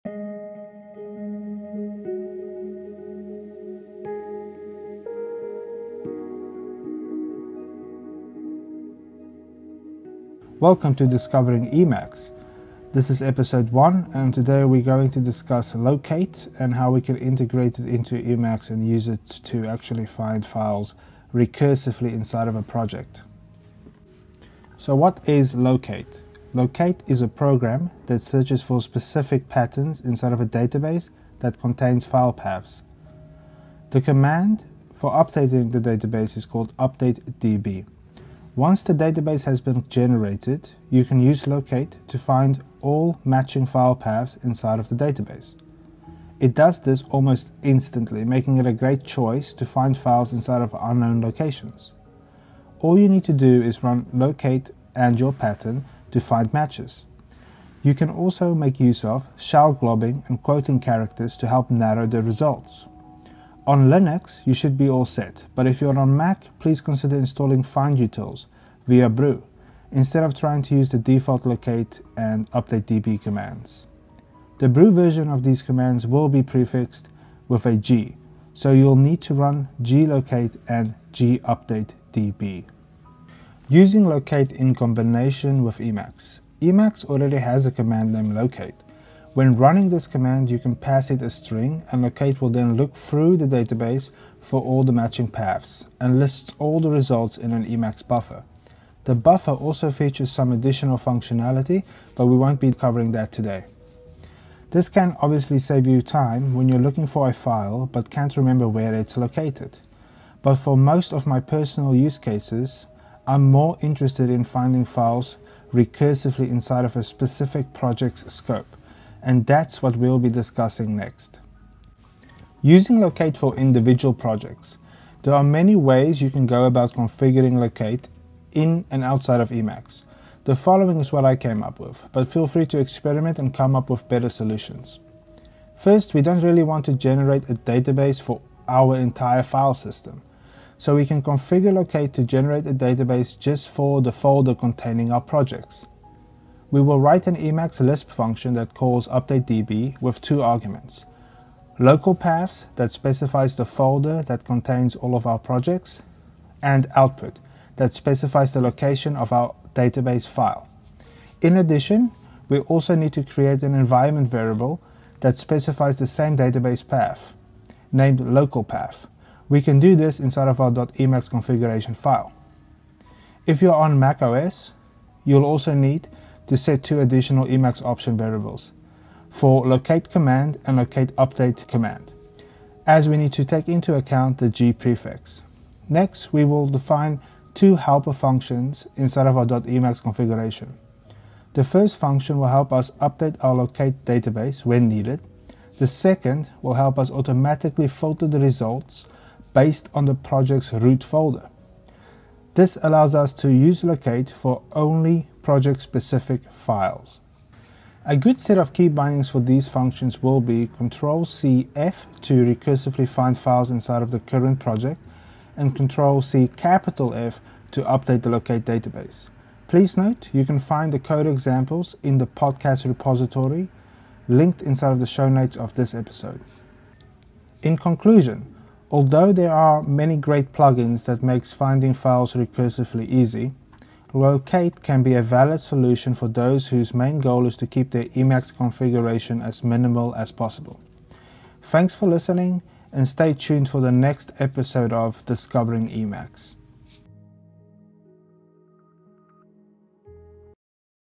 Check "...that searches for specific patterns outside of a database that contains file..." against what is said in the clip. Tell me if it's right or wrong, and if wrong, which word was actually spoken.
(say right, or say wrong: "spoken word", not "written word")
wrong: "inside", not "outside".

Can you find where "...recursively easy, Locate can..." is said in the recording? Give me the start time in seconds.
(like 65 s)
232 s.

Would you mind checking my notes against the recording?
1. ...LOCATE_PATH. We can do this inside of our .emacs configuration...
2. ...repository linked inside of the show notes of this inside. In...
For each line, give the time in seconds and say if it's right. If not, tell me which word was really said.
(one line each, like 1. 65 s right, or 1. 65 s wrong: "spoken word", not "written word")
1. 168 s right
2. 222 s wrong: "episode", not "inside".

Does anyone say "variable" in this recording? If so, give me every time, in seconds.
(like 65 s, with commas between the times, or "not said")
164 s, 178 s.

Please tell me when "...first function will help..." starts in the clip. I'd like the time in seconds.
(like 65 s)
191 s.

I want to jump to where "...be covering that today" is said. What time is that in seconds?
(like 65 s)
102 s.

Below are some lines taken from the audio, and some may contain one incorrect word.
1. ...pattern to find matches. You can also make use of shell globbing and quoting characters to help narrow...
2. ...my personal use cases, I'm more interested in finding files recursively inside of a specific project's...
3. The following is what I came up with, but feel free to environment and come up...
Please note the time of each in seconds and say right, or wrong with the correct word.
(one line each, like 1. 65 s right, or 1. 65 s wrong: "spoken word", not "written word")
1. 55 s right
2. 111 s right
3. 130 s wrong: "experiment", not "environment".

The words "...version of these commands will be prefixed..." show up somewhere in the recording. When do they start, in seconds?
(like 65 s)
74 s.